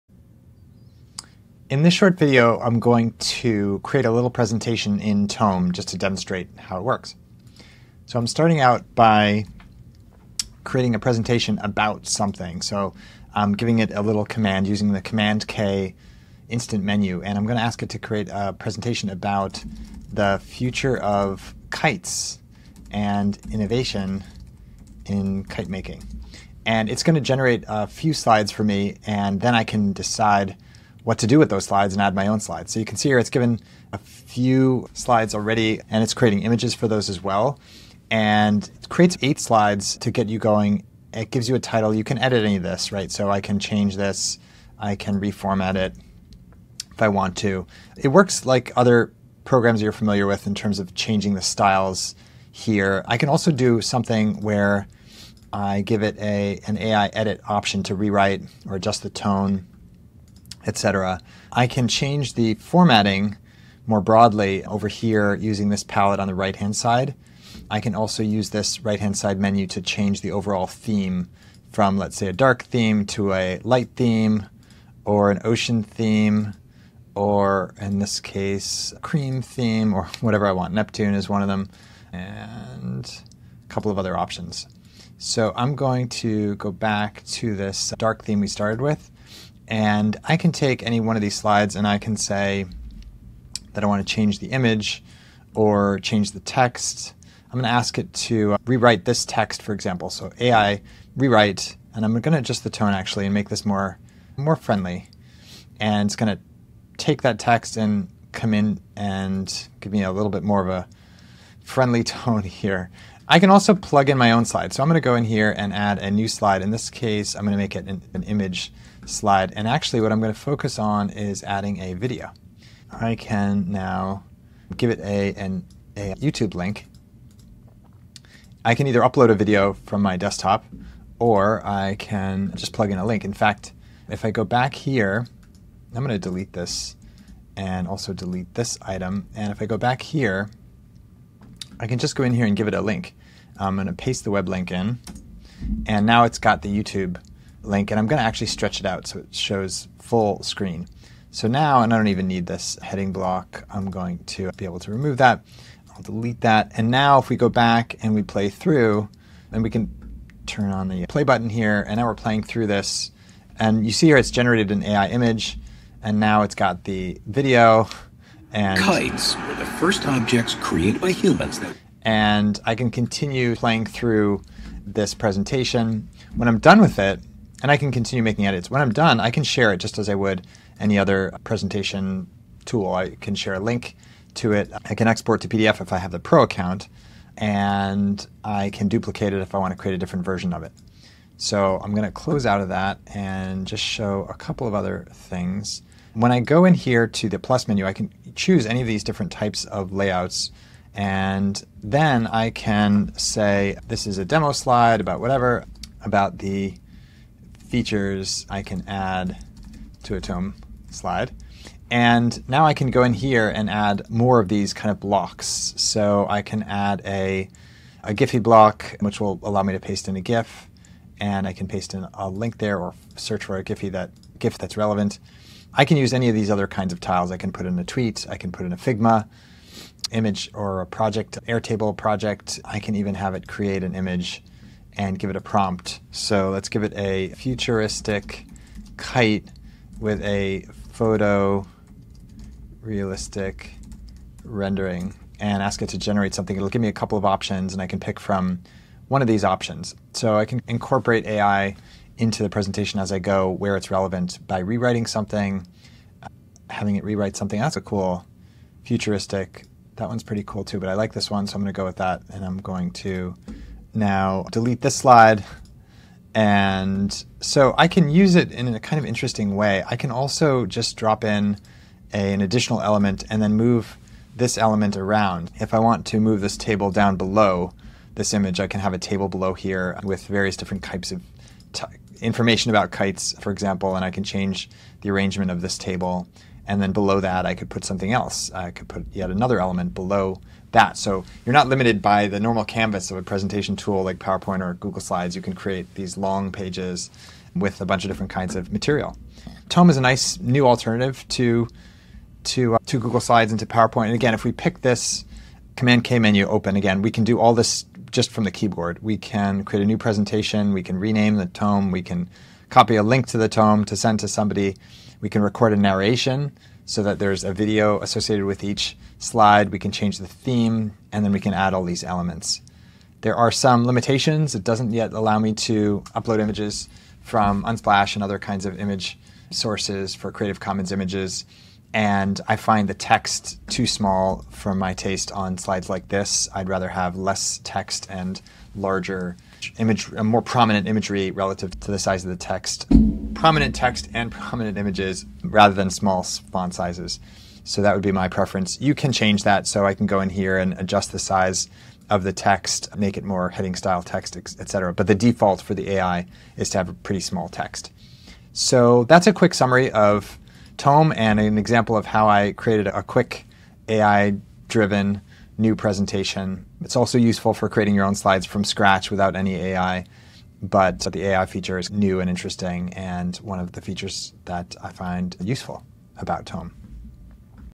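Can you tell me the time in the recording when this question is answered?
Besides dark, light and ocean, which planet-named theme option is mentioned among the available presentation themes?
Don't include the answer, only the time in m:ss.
1:20.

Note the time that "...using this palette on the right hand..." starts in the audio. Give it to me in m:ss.
1:05.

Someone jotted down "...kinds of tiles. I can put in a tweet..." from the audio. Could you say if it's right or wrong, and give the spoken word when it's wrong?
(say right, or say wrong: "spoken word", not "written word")
right.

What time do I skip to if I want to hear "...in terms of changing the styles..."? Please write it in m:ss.
0:50.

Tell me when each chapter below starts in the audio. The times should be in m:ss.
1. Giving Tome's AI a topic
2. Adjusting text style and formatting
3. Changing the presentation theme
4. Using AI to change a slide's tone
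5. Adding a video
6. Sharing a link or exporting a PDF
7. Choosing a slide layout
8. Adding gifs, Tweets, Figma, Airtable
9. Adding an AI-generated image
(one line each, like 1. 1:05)
1. 0:24
2. 0:50
3. 1:12
4. 1:40
5. 2:02
6. 3:00
7. 3:20
8. 3:37
9. 4:00.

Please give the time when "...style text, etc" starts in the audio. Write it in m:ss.
5:53.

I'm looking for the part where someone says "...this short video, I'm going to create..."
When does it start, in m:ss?
0:01.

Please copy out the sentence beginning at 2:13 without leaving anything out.
In fact, if I go back here, I'm going to delete this and also delete this item.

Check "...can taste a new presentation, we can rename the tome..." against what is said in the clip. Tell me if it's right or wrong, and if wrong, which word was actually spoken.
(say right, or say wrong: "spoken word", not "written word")
wrong: "create", not "taste".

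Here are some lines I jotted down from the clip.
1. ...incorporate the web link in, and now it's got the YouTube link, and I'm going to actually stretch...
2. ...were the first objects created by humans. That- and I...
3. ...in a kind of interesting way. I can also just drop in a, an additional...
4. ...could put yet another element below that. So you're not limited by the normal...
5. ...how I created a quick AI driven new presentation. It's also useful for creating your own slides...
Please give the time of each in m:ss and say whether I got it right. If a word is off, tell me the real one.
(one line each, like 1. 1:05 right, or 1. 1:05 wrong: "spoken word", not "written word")
1. 2:23 wrong: "paste", not "incorporate"
2. 2:49 right
3. 4:28 right
4. 4:48 right
5. 6:02 right.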